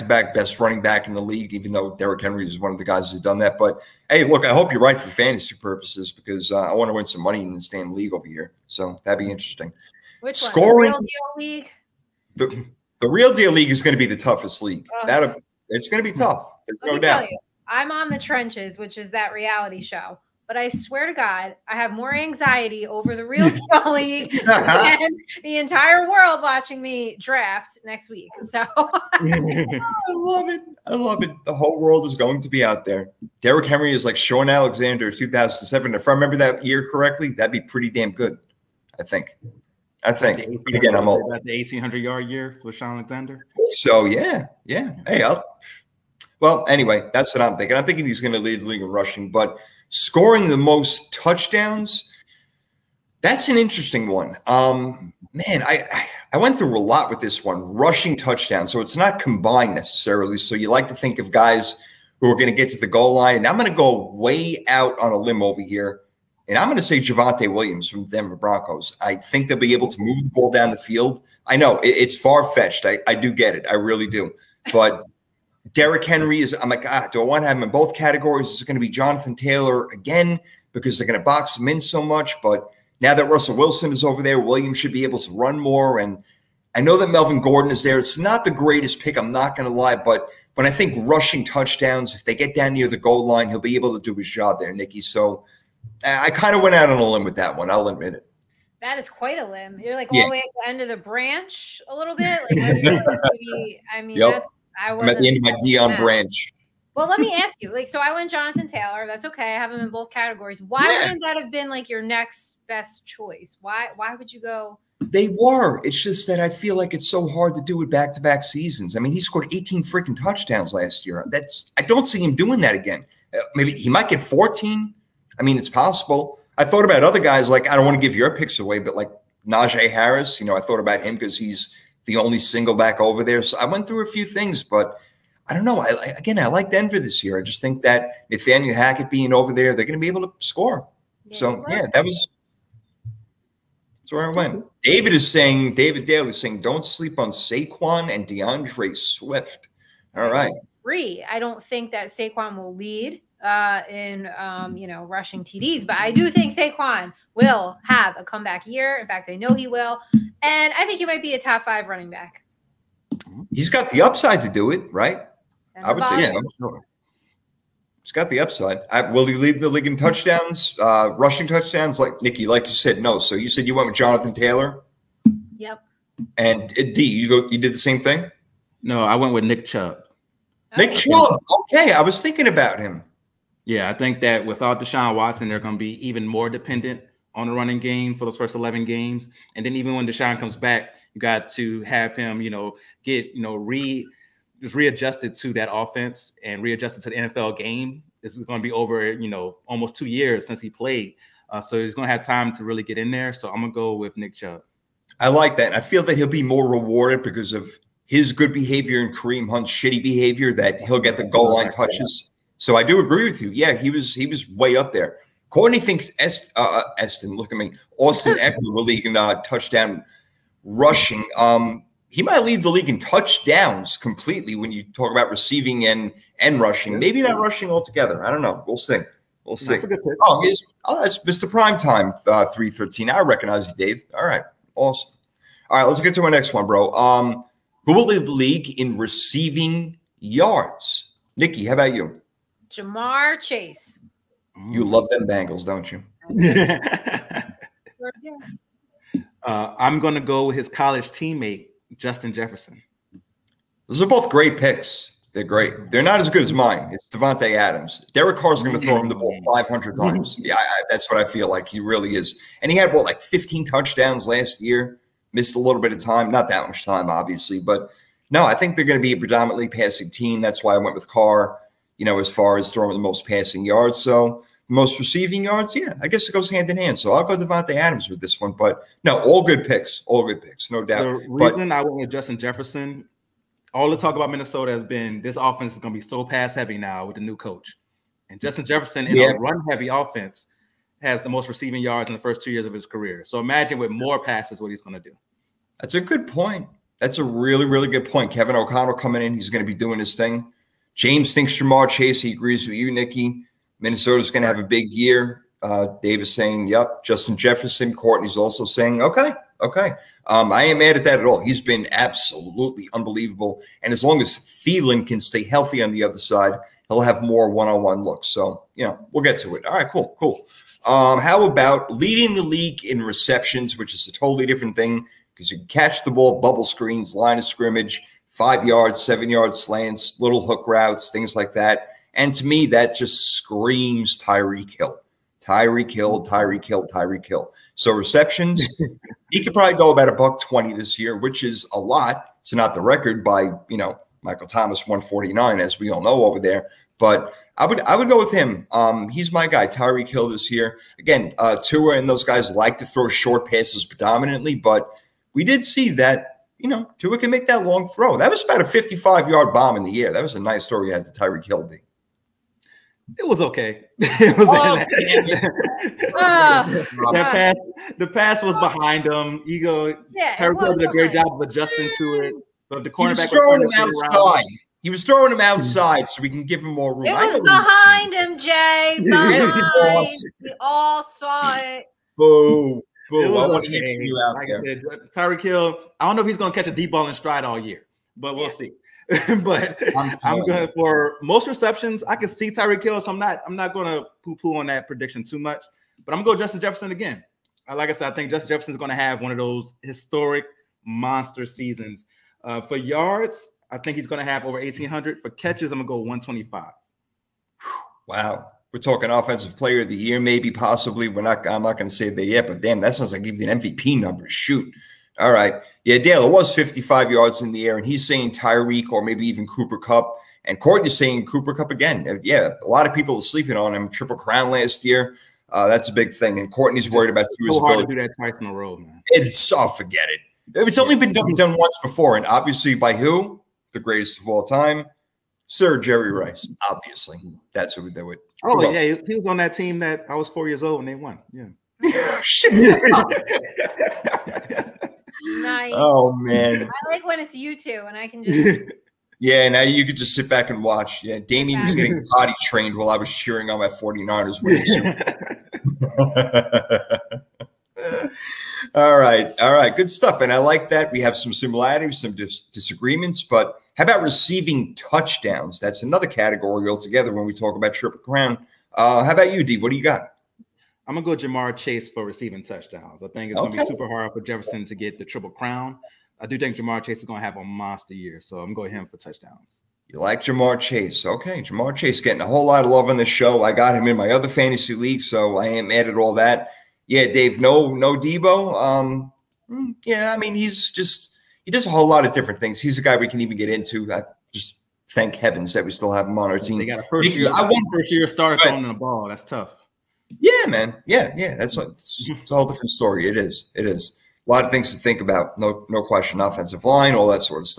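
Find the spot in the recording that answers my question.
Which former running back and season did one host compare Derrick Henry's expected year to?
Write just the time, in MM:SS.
00:34.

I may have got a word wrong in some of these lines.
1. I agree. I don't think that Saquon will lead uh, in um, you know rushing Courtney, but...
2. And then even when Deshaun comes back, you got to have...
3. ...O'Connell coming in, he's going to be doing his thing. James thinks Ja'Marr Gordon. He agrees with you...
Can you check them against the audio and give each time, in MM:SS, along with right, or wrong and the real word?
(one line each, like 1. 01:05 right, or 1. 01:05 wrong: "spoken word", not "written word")
1. 02:30 wrong: "TDs", not "Courtney"
2. 03:09 right
3. 04:58 wrong: "Chase", not "Gordon".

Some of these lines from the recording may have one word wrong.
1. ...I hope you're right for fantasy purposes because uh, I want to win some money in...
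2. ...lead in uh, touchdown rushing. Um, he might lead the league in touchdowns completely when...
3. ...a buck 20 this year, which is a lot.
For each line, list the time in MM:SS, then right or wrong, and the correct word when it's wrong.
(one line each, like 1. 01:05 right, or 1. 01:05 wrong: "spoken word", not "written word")
1. 00:04 right
2. 03:38 right
3. 05:40 right.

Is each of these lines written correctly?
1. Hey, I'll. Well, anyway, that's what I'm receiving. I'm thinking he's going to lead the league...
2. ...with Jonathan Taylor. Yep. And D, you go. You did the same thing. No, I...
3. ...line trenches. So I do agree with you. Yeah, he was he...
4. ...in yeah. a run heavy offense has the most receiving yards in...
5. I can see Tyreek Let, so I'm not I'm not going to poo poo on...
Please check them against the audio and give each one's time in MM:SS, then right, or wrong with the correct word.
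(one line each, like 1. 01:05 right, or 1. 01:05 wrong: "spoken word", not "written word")
1. 00:45 wrong: "thinking", not "receiving"
2. 02:53 right
3. 03:31 wrong: "touches", not "trenches"
4. 04:49 right
5. 06:32 wrong: "Hill", not "Let".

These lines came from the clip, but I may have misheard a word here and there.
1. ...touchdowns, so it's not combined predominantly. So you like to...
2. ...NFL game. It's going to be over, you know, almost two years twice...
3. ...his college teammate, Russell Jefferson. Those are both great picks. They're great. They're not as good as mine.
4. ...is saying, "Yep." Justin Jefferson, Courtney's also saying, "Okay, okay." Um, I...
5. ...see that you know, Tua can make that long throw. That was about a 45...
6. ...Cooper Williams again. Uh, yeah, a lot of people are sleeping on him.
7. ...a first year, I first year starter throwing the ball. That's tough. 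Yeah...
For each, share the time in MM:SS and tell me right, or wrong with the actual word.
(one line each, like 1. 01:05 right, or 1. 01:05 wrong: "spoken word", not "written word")
1. 00:58 wrong: "necessarily", not "predominantly"
2. 03:17 wrong: "since", not "twice"
3. 04:10 wrong: "Justin", not "Russell"
4. 05:06 right
5. 05:55 wrong: "55", not "45"
6. 07:01 wrong: "Kupp", not "Williams"
7. 08:16 right.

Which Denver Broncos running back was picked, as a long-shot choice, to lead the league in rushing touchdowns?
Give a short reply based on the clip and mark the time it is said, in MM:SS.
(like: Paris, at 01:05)
Javonte Williams, at 01:06.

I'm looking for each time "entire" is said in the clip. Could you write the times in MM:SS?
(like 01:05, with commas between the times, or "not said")
00:25.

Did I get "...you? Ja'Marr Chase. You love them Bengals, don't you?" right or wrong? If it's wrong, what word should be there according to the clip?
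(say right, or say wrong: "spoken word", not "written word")
right.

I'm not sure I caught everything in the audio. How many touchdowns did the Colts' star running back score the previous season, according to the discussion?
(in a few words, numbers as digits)
18.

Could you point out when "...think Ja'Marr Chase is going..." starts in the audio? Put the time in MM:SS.
07:56.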